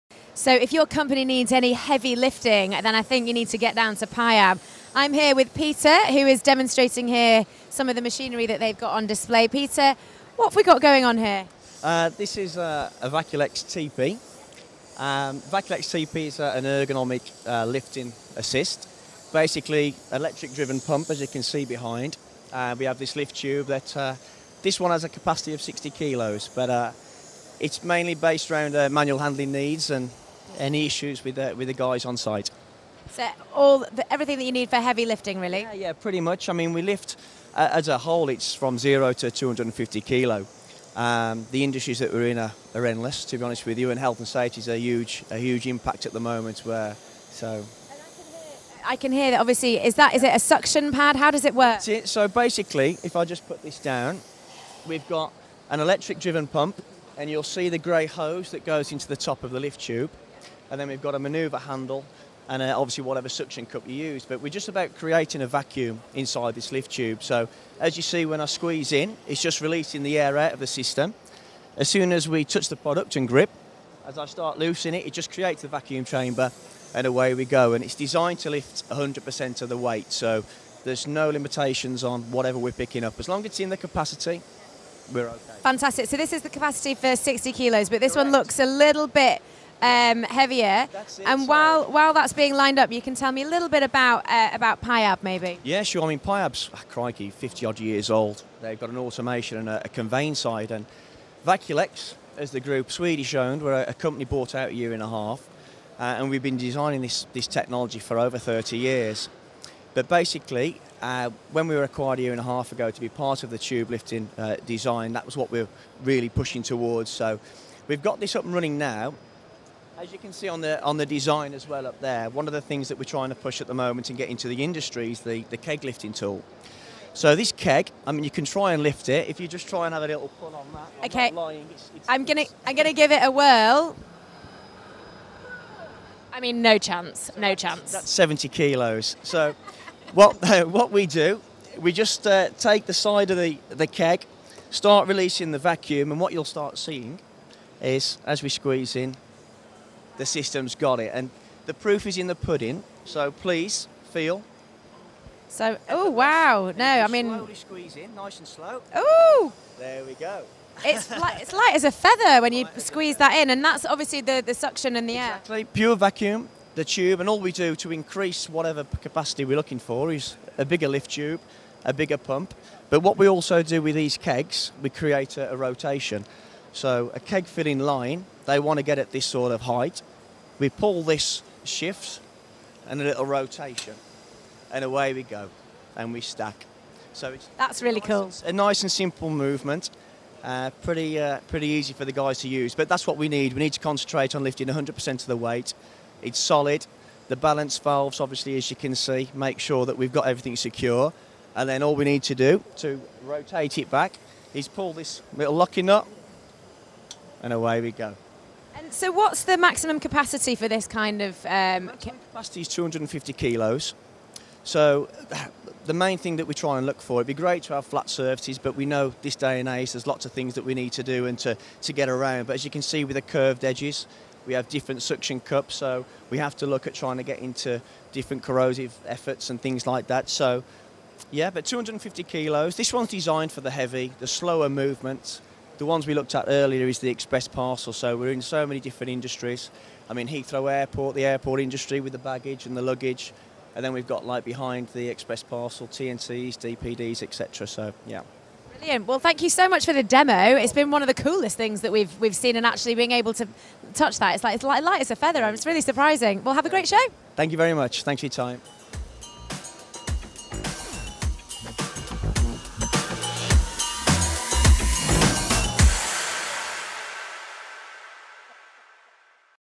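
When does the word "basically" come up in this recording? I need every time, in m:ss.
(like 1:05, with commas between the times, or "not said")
0:19, 0:52, 1:50.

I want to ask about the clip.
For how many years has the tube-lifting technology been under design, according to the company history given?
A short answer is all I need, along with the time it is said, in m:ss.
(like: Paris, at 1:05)
over 30 years, at 1:48.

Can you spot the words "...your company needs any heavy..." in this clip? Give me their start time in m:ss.
0:00.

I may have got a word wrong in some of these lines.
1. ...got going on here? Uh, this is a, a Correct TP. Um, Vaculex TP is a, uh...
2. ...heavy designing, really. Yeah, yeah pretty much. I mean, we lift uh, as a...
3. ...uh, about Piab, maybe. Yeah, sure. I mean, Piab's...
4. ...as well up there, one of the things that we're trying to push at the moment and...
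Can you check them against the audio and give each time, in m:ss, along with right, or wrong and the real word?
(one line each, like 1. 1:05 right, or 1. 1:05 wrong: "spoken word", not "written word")
1. 0:10 wrong: "Vaculex", not "Correct"
2. 0:34 wrong: "lifting", not "designing"
3. 1:34 right
4. 2:01 right.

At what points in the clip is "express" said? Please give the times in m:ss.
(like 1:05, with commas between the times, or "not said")
3:57, 4:05.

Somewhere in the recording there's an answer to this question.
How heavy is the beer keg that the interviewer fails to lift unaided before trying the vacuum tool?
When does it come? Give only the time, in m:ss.
2:18.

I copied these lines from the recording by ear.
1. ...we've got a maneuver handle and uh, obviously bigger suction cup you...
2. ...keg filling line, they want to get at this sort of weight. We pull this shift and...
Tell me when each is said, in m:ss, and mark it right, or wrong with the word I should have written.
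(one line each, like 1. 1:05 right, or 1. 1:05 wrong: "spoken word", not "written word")
1. 1:00 wrong: "whatever", not "bigger"
2. 2:57 wrong: "height", not "weight".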